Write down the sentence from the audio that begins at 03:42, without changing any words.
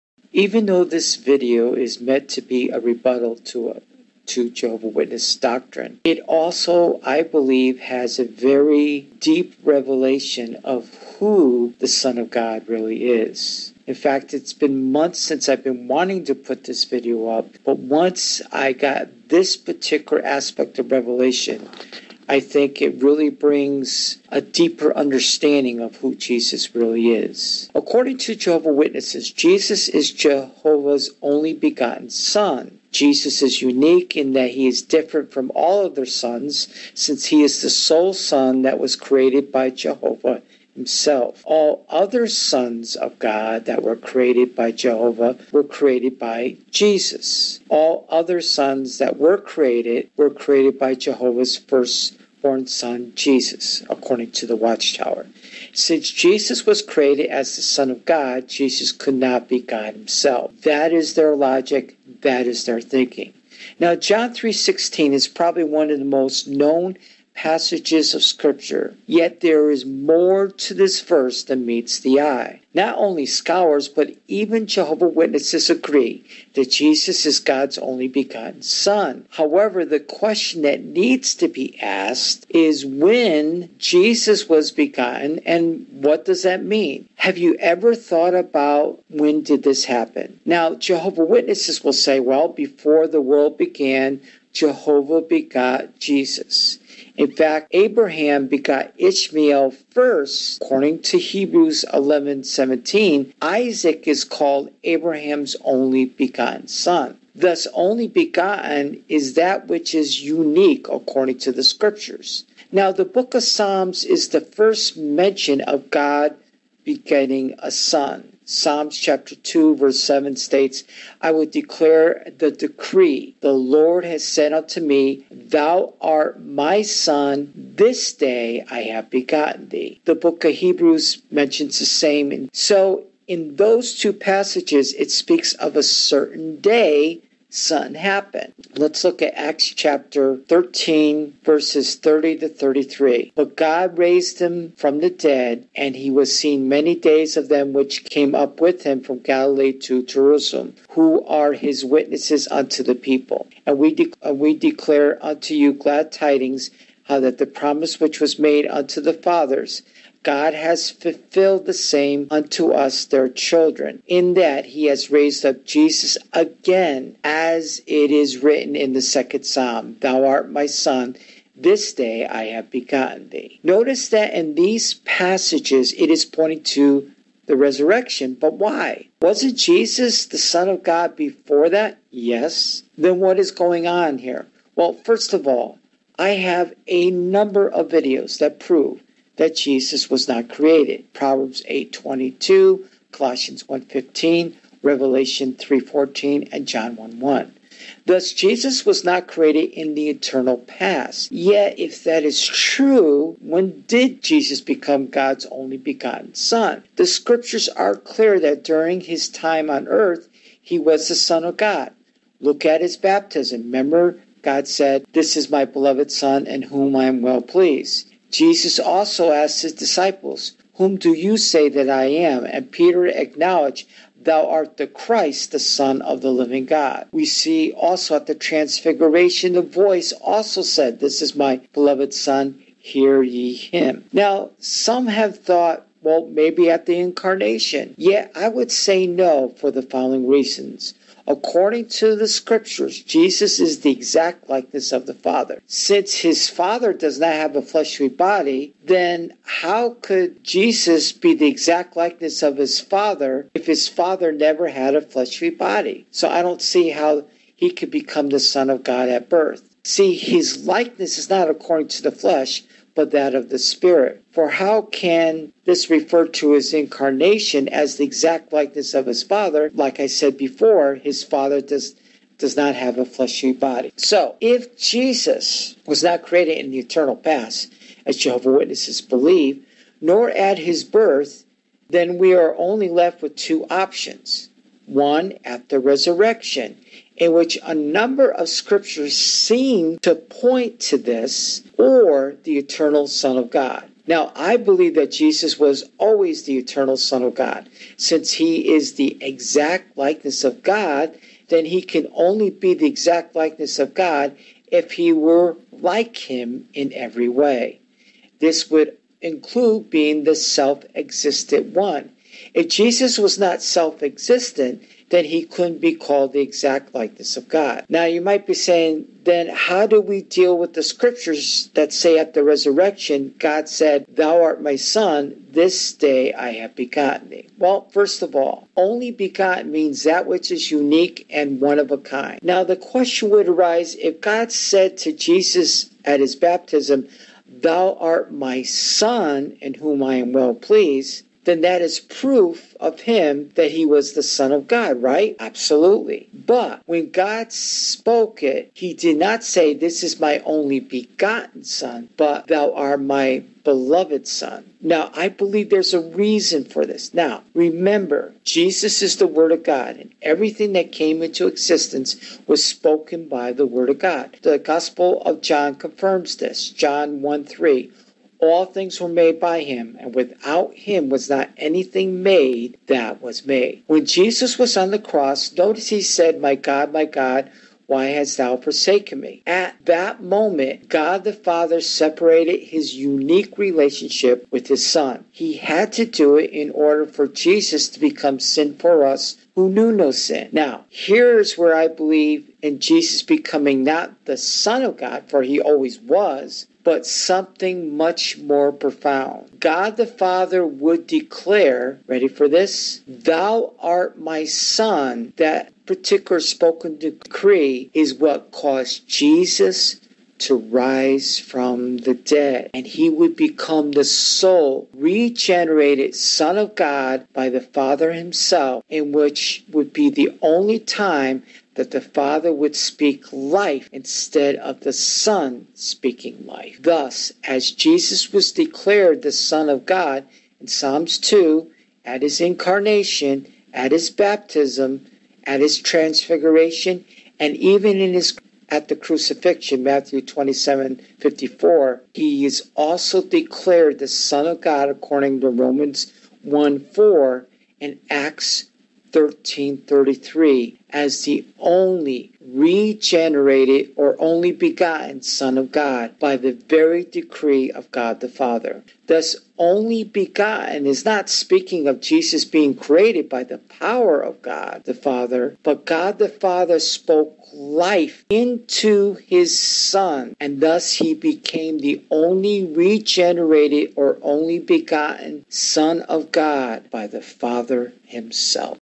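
And Peter acknowledged, Thou art the Christ, the Son of the living God.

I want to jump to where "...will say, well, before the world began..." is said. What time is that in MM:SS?
01:31.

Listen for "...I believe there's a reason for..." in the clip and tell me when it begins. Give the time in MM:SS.
05:55.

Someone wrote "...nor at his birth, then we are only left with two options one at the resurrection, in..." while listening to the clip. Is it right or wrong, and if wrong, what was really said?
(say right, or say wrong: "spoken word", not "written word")
right.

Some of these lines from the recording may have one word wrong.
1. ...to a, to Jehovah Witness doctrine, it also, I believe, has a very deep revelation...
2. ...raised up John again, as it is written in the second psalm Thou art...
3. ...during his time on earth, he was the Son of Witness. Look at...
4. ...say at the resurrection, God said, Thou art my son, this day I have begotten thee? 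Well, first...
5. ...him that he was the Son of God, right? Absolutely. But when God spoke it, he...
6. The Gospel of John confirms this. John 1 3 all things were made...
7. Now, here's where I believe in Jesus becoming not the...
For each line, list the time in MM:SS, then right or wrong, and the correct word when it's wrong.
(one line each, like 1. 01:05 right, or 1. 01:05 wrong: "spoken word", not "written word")
1. 00:03 right
2. 02:45 wrong: "Jesus", not "John"
3. 03:28 wrong: "God", not "Witness"
4. 05:21 right
5. 05:43 right
6. 06:04 right
7. 06:30 right.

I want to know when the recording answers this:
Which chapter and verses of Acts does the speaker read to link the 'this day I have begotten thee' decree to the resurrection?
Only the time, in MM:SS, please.
02:19.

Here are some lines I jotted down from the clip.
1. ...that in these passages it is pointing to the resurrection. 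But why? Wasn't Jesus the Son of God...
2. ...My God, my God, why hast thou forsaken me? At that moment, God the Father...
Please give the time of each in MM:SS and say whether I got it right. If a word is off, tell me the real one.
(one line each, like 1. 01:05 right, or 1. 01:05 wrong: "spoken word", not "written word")
1. 02:54 right
2. 06:16 right.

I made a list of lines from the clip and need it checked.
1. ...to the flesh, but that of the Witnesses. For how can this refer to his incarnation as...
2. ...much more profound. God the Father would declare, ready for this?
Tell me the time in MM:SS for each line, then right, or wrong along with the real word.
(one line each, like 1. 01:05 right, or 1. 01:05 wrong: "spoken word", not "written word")
1. 04:21 wrong: "Spirit", not "Witnesses"
2. 06:37 right.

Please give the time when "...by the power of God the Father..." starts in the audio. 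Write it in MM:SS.
07:43.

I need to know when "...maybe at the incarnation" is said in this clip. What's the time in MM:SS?
03:56.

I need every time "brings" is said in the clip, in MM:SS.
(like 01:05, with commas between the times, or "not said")
00:23.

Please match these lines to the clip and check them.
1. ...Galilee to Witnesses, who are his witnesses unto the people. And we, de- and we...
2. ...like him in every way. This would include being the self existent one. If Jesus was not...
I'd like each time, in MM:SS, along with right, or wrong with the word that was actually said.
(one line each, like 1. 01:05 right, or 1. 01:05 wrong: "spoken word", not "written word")
1. 02:29 wrong: "Jerusalem", not "Witnesses"
2. 05:05 right.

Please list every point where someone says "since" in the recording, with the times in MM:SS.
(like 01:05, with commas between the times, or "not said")
00:15, 00:36, 00:55, 04:05, 04:57.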